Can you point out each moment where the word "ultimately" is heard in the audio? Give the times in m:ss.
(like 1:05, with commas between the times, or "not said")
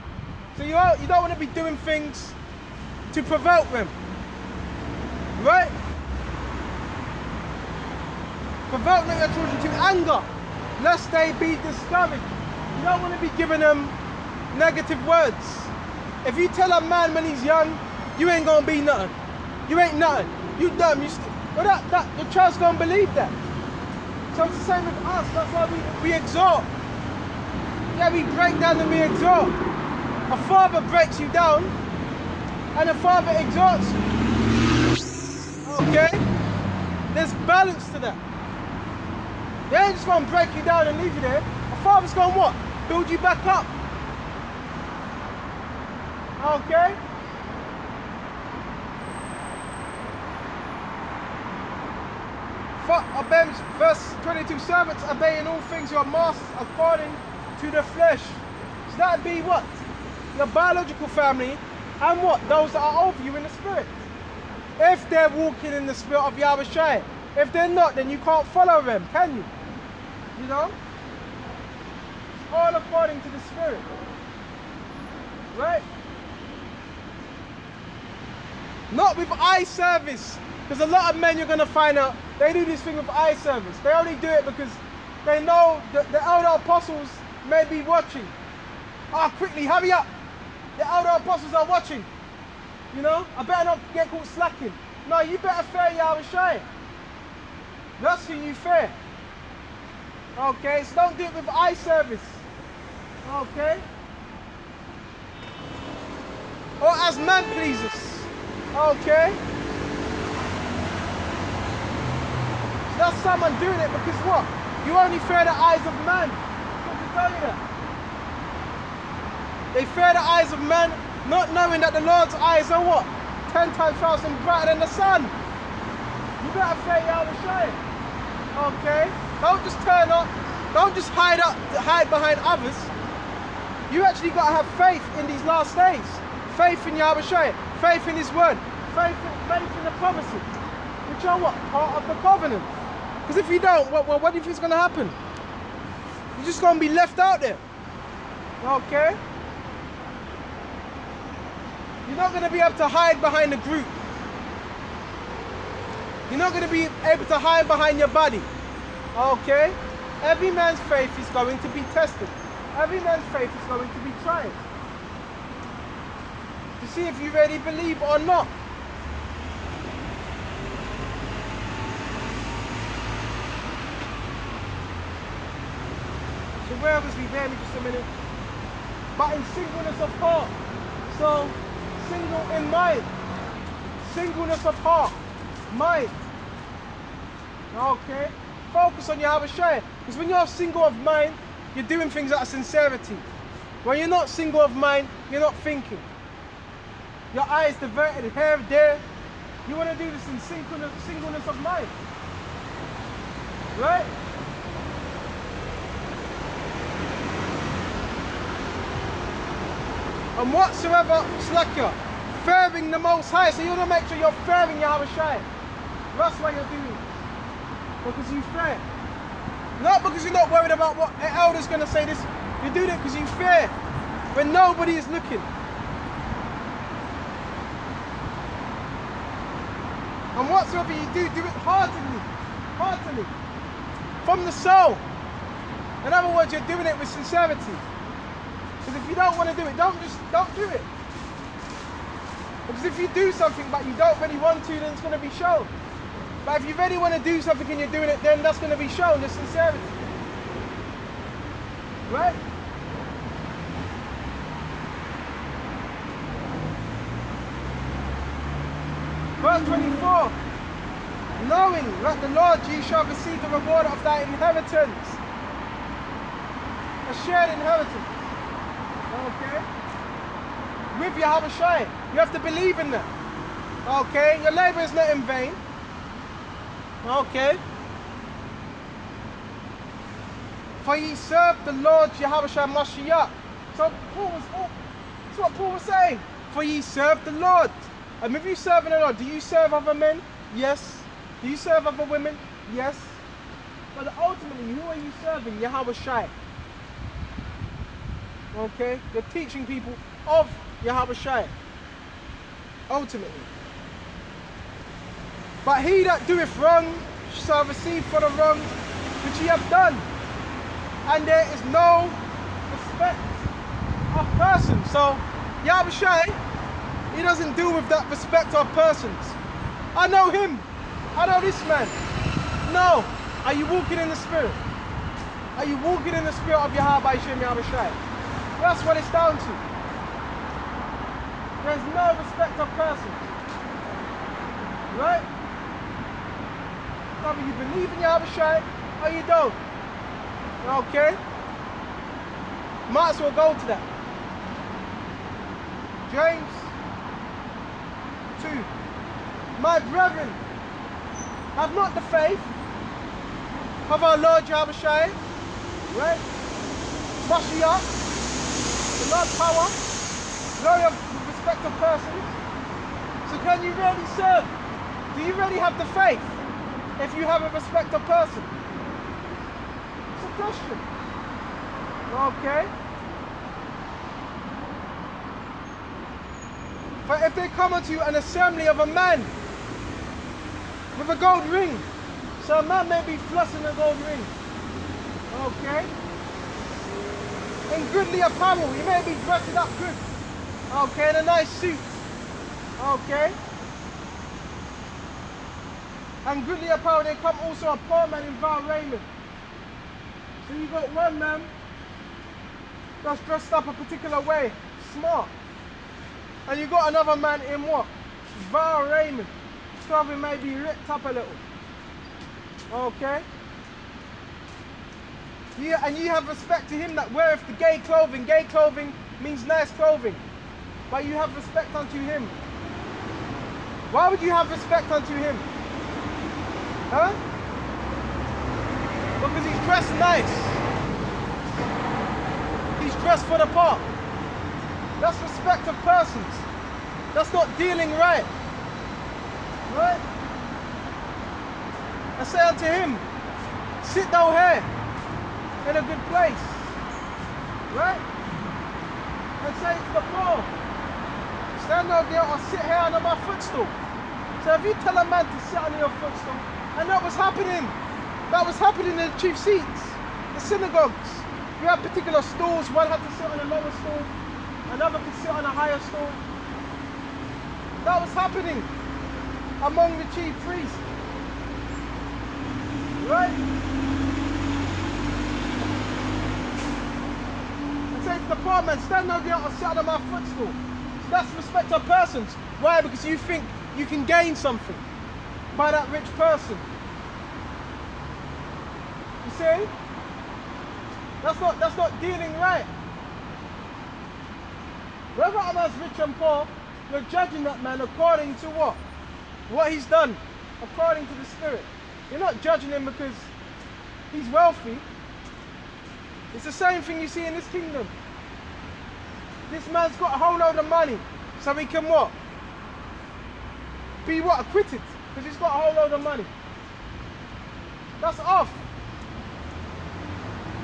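4:54, 5:02.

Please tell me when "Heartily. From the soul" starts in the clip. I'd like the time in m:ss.
3:52.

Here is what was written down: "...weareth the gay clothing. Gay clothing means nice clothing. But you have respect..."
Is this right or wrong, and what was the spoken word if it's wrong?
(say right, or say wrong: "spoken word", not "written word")
right.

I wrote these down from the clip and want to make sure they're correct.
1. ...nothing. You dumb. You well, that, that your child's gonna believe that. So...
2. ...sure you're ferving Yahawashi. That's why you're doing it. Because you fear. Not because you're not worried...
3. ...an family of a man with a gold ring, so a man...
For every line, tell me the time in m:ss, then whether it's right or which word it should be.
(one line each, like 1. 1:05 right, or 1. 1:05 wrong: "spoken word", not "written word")
1. 0:19 right
2. 3:34 right
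3. 6:18 wrong: "assembly", not "family".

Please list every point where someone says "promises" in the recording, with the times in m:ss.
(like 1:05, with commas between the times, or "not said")
2:20.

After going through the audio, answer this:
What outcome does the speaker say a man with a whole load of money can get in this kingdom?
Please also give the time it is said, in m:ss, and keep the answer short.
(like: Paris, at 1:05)
Acquitted, at 8:34.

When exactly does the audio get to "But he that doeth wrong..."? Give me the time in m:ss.
5:05.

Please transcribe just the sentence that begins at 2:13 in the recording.
You actually got to have faith in these last days.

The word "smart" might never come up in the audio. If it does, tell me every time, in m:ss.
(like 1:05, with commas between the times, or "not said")
6:44.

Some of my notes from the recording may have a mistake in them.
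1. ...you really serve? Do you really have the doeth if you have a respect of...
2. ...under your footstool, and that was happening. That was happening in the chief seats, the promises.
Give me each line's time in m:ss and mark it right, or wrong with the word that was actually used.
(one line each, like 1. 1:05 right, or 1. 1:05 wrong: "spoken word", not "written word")
1. 6:03 wrong: "faith", not "doeth"
2. 7:35 wrong: "synagogues", not "promises".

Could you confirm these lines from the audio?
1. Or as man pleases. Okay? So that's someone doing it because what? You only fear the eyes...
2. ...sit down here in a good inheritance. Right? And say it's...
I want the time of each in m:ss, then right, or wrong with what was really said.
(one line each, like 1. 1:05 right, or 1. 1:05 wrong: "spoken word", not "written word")
1. 1:46 right
2. 7:23 wrong: "place", not "inheritance".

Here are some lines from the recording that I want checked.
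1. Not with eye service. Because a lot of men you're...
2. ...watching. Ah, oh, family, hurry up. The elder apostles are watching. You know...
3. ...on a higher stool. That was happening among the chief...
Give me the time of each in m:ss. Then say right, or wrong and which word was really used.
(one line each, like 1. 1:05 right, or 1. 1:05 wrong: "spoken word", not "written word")
1. 1:18 right
2. 1:27 wrong: "quickly", not "family"
3. 7:45 right.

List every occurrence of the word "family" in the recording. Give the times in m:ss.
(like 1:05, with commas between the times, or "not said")
1:01.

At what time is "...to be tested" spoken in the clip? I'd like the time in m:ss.
2:41.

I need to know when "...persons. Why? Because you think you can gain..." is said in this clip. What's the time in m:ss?
8:01.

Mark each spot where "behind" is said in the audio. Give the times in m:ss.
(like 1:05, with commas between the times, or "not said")
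2:12, 2:33, 2:37.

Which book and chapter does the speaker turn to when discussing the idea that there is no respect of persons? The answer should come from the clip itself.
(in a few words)
James 2.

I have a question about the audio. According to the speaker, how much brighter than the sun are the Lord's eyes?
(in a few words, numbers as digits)
Ten times thousand.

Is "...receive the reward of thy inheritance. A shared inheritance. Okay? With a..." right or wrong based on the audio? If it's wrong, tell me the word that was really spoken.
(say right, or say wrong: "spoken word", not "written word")
right.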